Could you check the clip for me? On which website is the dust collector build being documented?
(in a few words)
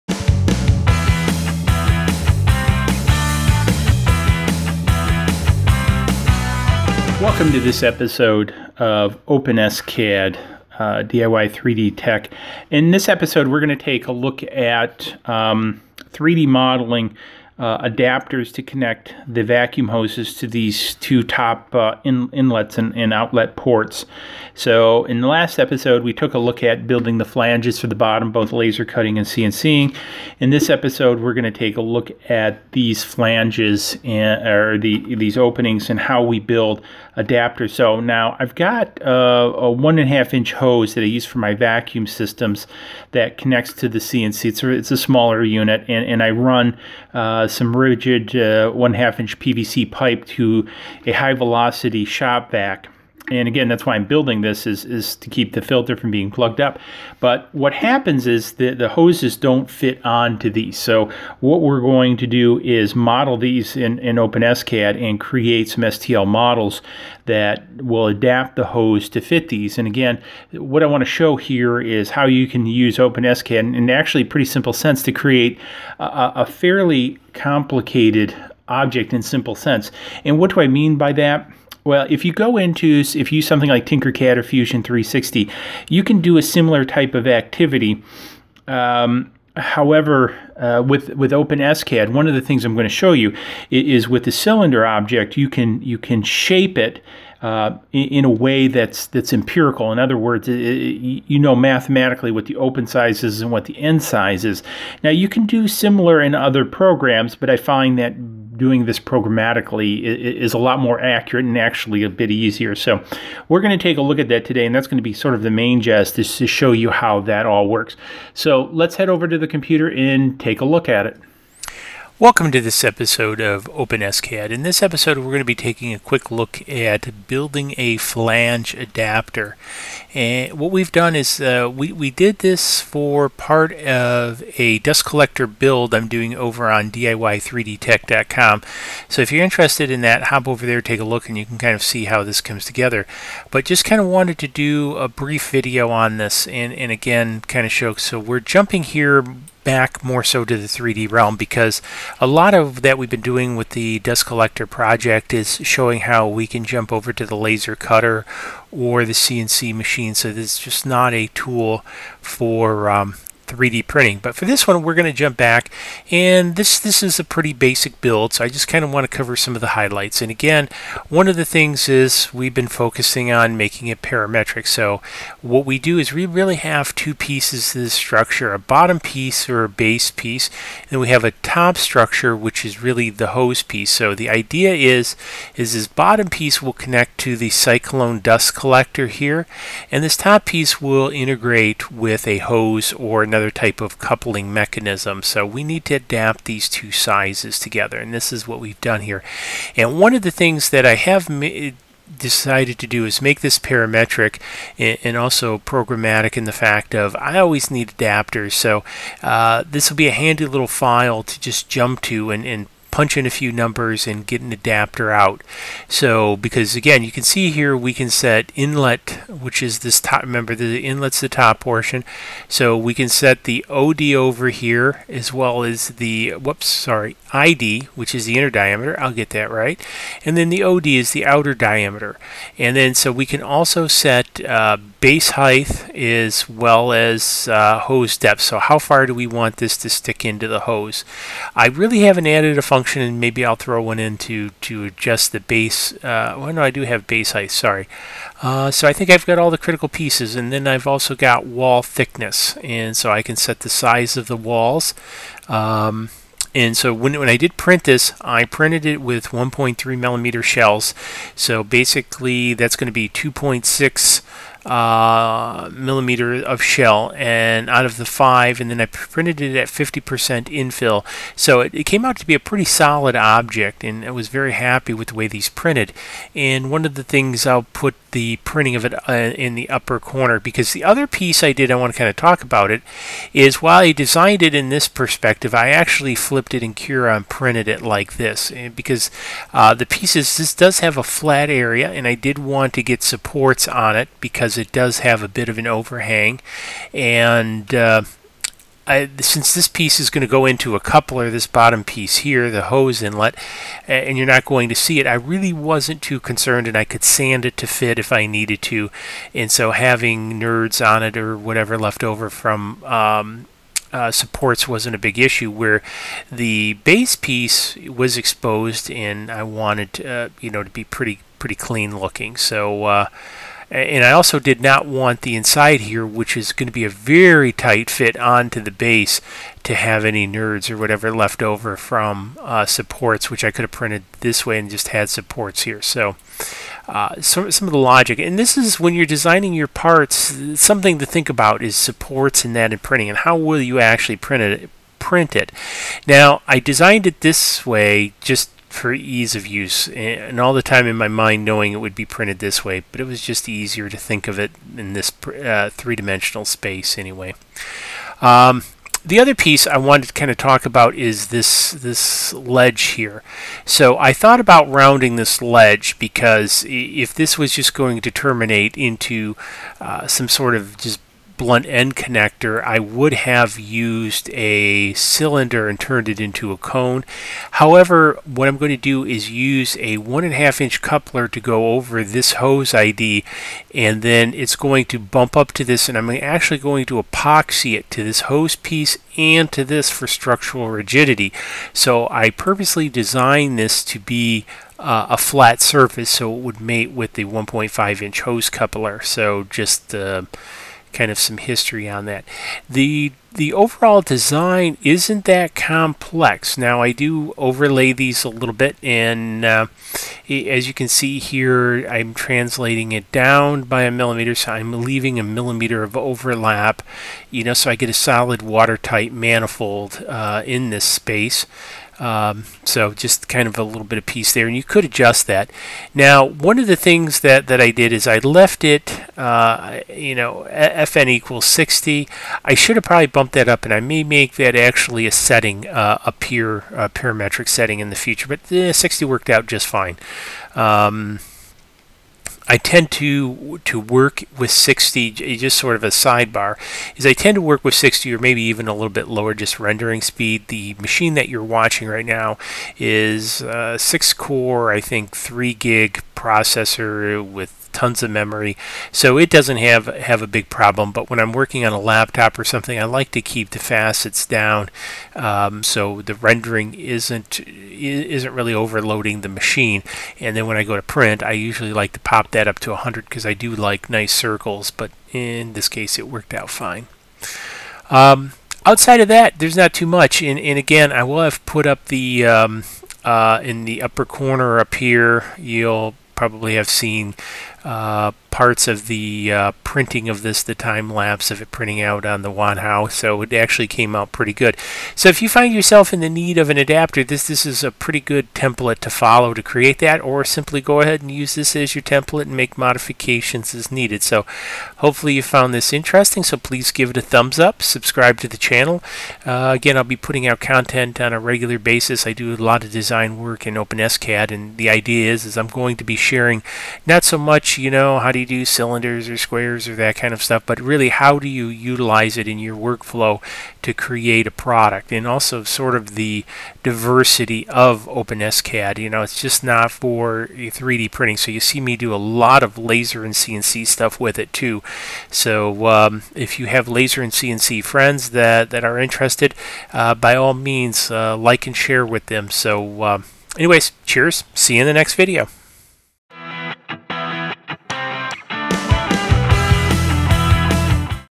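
DIY3DTech.com.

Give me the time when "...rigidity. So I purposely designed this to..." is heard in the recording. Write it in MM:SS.
06:30.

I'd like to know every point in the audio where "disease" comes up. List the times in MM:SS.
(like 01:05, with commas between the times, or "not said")
not said.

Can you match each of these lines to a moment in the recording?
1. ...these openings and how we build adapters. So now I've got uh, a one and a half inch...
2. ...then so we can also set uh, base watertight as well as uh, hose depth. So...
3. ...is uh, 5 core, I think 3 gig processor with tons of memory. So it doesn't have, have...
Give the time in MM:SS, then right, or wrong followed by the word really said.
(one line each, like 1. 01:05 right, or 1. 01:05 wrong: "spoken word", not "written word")
1. 00:35 right
2. 03:52 wrong: "height", not "watertight"
3. 07:32 wrong: "6", not "5".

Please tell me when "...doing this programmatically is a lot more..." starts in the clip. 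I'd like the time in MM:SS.
01:48.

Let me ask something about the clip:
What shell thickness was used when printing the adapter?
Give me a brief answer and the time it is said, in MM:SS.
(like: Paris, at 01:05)
1.3 millimeters, at 04:19.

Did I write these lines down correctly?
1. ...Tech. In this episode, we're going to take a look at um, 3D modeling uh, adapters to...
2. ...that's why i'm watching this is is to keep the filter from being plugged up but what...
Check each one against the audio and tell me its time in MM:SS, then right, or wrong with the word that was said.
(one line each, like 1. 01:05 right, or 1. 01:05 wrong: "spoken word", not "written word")
1. 00:11 right
2. 00:53 wrong: "building", not "watching".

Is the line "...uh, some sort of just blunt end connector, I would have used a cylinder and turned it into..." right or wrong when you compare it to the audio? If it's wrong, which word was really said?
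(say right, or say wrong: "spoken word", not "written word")
right.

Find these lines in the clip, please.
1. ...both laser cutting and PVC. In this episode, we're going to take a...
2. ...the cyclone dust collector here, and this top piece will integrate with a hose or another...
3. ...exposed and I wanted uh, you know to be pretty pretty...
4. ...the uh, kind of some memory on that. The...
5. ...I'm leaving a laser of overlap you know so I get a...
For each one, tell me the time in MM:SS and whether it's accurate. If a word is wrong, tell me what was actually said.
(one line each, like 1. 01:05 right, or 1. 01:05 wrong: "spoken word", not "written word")
1. 00:28 wrong: "CNCing", not "PVC"
2. 03:07 right
3. 05:18 right
4. 06:39 wrong: "history", not "memory"
5. 06:54 wrong: "millimeter", not "laser".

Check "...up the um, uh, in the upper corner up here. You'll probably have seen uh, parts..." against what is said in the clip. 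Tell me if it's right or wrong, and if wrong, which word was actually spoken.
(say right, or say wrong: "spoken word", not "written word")
right.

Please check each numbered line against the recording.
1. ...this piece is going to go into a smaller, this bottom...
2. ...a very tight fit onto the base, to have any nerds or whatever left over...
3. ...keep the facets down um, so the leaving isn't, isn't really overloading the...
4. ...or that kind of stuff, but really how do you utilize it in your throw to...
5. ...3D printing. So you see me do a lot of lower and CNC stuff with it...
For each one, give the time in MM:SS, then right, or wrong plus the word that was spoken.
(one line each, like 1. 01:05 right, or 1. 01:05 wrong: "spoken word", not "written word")
1. 04:59 wrong: "coupler", not "smaller"
2. 05:26 right
3. 07:43 wrong: "rendering", not "leaving"
4. 08:39 wrong: "workflow", not "throw"
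5. 08:50 wrong: "laser", not "lower".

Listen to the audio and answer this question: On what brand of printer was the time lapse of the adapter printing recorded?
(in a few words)
Wanhao.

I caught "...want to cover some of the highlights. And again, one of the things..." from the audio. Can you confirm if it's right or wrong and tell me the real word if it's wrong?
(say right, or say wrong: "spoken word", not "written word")
right.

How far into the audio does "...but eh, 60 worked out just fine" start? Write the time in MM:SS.
07:18.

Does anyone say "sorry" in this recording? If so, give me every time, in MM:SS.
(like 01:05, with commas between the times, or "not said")
03:46, 04:07.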